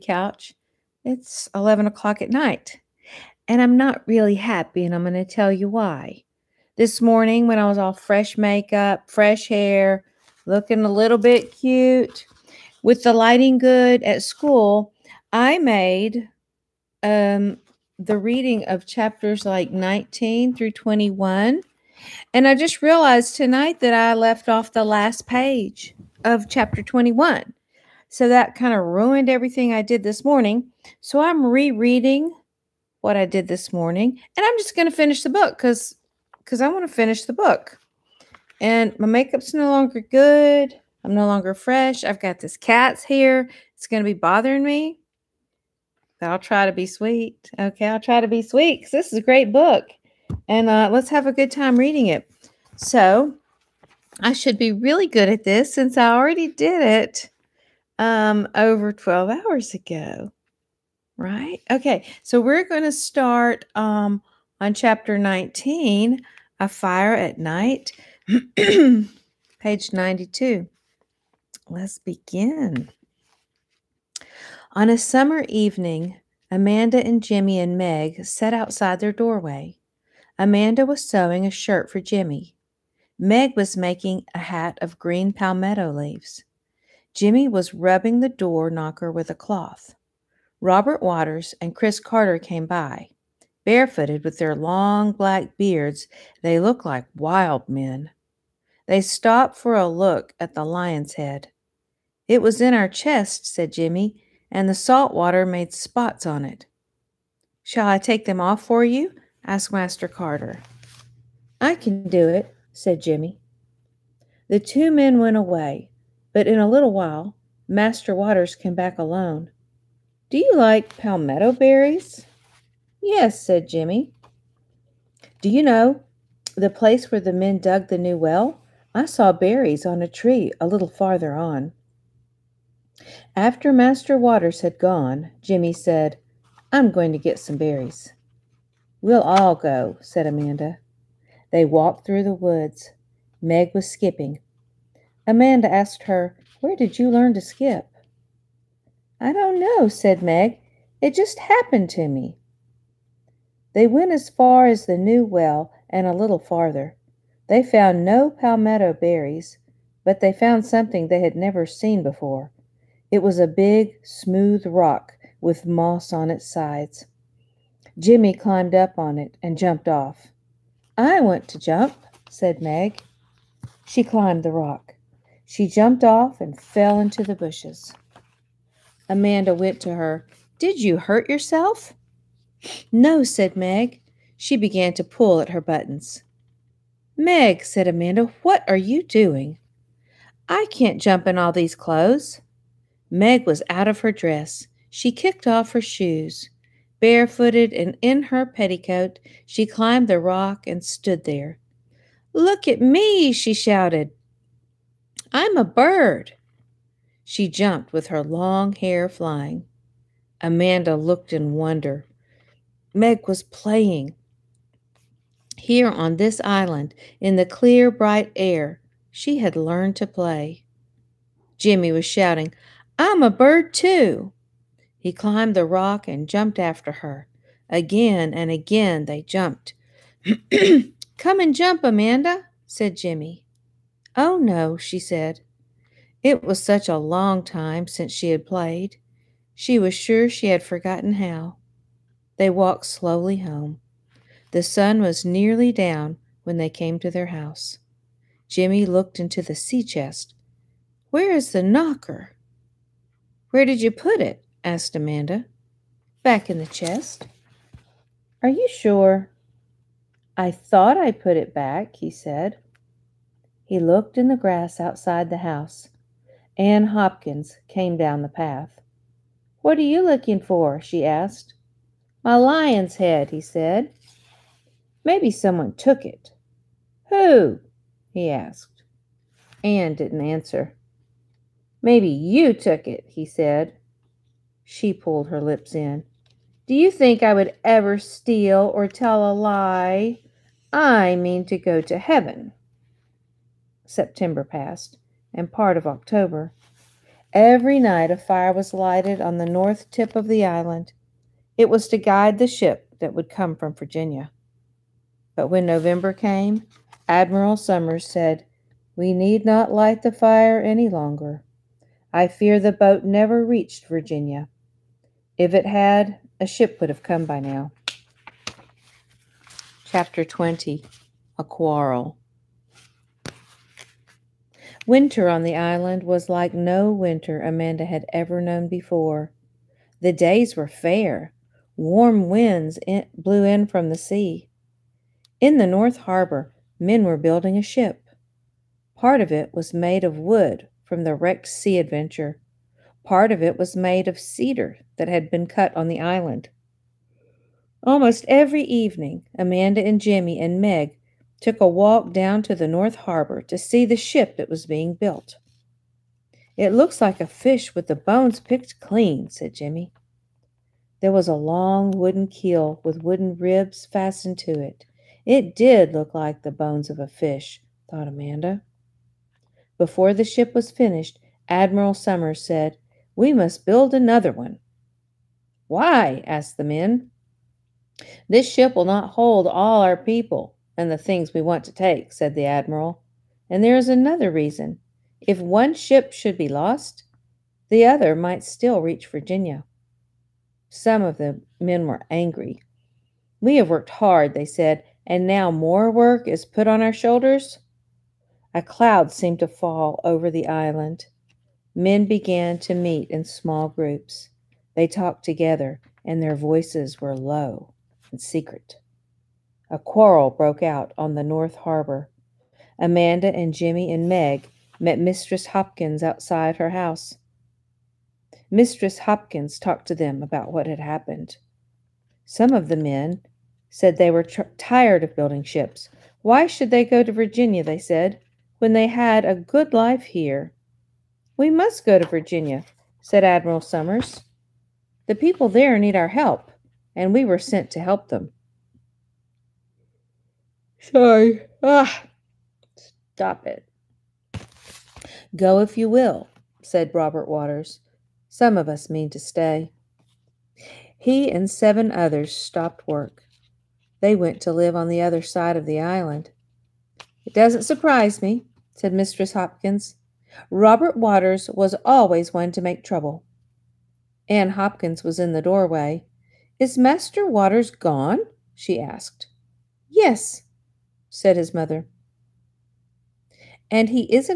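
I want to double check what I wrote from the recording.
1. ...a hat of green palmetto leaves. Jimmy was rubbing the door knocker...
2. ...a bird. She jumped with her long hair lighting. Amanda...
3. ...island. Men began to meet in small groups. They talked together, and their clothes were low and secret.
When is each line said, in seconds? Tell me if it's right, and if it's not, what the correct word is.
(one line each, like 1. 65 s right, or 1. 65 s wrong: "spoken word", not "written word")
1. 84 s right
2. 205 s wrong: "flying", not "lighting"
3. 400 s wrong: "voices", not "clothes".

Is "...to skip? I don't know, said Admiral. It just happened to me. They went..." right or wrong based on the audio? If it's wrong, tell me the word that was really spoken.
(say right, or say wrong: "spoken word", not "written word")
wrong: "Meg", not "Admiral".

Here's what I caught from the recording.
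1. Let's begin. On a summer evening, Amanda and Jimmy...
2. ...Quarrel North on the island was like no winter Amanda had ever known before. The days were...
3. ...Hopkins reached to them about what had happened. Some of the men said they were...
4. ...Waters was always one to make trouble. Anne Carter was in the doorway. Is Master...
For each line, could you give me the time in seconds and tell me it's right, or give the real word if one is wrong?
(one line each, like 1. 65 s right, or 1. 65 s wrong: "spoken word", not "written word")
1. 71 s right
2. 321 s wrong: "Winter", not "North"
3. 418 s wrong: "talked", not "reached"
4. 460 s wrong: "Hopkins", not "Carter".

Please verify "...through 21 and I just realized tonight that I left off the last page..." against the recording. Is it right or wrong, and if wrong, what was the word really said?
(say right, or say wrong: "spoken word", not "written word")
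right.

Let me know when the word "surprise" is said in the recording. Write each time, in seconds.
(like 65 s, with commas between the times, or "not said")
457 s.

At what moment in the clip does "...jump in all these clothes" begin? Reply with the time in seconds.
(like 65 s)
191 s.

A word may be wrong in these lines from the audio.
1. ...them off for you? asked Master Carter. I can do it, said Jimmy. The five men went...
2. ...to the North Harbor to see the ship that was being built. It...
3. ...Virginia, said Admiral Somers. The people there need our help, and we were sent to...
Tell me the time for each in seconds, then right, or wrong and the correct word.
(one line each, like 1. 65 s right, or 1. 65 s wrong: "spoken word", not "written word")
1. 108 s wrong: "two", not "five"
2. 352 s right
3. 432 s right.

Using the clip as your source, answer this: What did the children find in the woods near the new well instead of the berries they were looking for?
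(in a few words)
a big, smooth rock.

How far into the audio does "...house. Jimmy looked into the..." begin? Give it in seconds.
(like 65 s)
247 s.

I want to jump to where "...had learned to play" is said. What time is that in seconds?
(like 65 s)
219 s.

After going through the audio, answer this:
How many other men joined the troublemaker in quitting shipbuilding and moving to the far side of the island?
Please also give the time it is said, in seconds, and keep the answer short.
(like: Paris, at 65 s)
7, at 451 s.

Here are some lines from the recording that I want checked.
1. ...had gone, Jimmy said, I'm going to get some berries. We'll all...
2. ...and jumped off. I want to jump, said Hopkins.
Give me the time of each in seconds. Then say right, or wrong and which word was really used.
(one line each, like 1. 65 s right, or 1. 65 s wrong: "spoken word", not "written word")
1. 134 s right
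2. 169 s wrong: "Meg", not "Hopkins".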